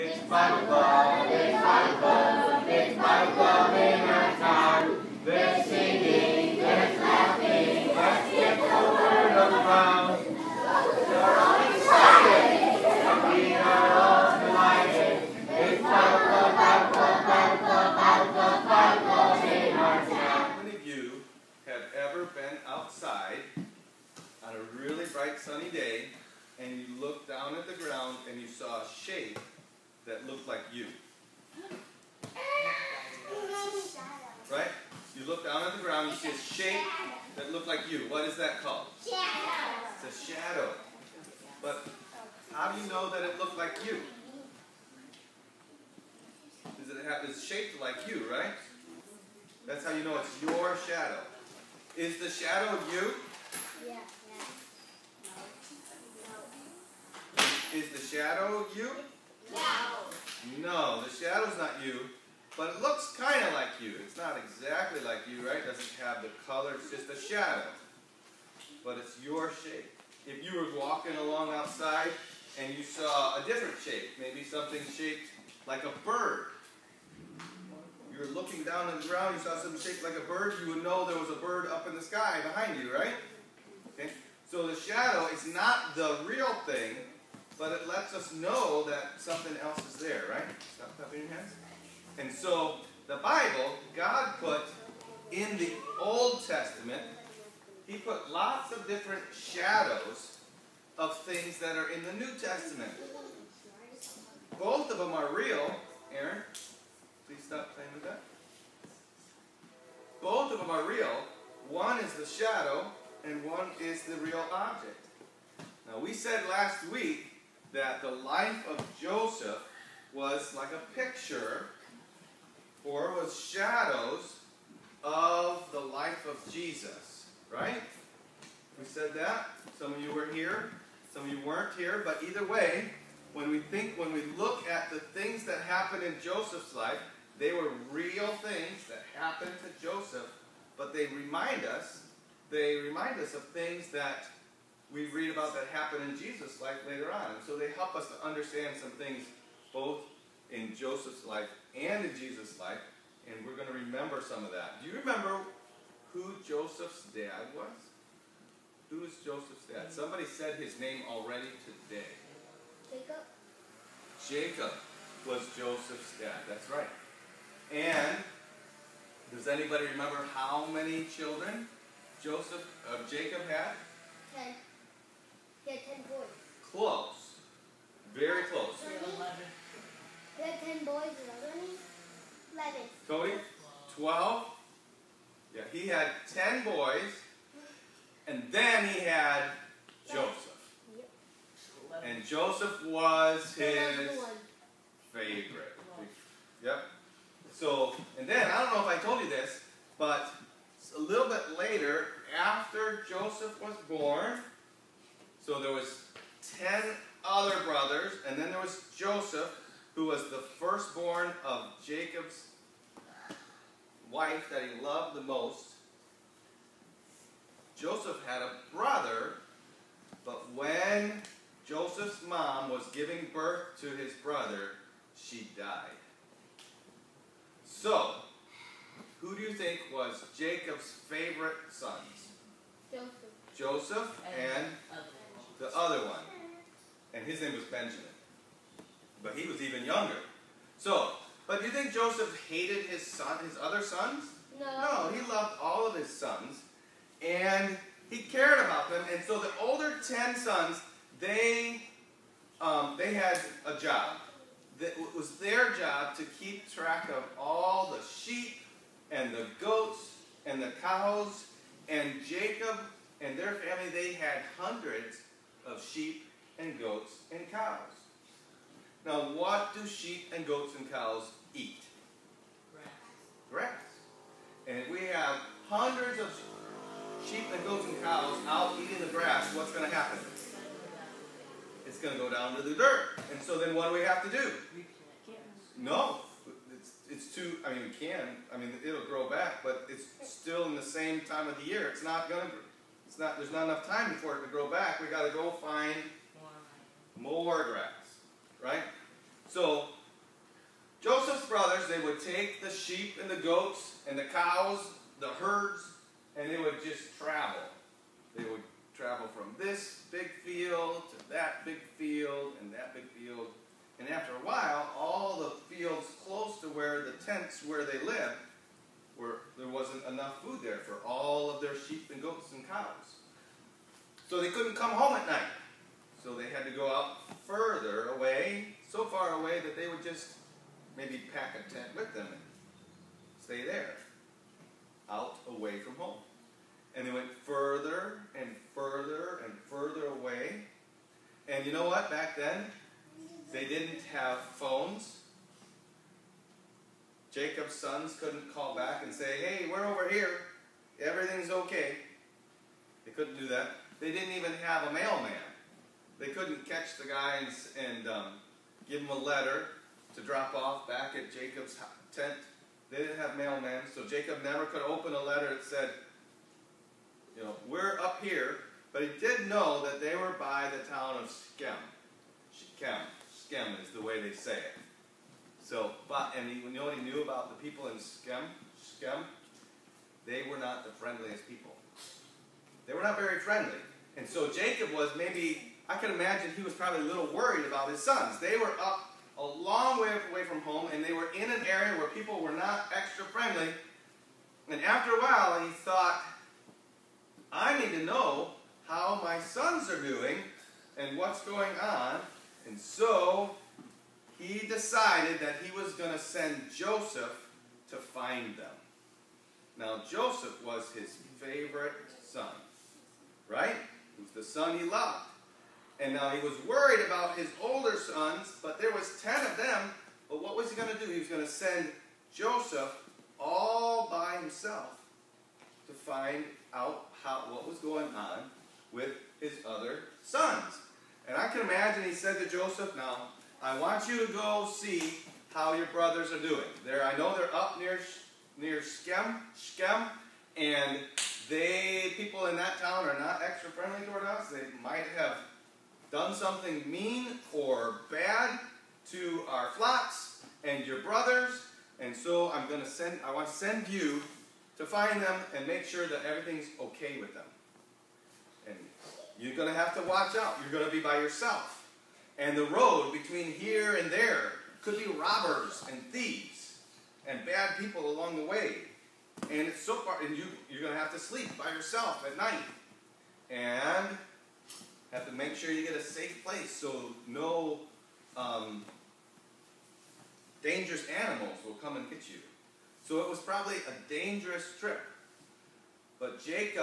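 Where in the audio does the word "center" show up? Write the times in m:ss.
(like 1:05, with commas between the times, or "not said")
not said.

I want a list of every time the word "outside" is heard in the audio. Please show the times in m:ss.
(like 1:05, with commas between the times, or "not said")
1:11.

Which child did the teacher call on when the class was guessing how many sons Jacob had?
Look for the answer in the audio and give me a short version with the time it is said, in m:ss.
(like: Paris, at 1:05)
Cody, at 3:03.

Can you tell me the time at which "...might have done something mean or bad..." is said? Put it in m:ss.
7:24.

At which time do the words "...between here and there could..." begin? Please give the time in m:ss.
7:43.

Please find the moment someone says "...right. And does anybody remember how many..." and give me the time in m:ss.
2:46.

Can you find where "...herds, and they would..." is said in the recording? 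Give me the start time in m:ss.
5:05.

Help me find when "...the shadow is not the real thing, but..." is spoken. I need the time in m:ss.
1:24.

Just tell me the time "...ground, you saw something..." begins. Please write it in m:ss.
1:19.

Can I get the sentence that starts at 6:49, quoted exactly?
Now, Joseph was his favorite son, right?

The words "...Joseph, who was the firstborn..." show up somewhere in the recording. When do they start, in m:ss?
3:28.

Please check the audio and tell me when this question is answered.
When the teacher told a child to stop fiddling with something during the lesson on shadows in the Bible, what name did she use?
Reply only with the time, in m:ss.
1:46.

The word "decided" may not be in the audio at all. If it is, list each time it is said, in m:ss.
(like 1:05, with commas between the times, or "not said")
6:44.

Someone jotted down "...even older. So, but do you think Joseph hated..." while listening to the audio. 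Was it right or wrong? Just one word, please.
wrong.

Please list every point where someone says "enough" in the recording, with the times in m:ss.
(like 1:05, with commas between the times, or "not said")
4:53, 5:20.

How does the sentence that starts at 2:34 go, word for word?
Do you remember who Joseph's dad was?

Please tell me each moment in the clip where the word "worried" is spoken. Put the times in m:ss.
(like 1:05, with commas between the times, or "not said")
6:27, 6:56.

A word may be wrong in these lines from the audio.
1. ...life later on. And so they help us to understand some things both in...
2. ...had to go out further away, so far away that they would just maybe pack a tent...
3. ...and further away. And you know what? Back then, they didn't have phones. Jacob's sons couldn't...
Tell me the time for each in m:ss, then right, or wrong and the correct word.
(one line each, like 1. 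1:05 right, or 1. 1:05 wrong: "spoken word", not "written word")
1. 2:26 right
2. 5:26 right
3. 5:39 right.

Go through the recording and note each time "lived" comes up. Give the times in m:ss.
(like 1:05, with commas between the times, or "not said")
5:18.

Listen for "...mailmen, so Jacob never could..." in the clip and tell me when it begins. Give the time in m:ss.
6:03.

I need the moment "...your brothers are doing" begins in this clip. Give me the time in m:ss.
7:15.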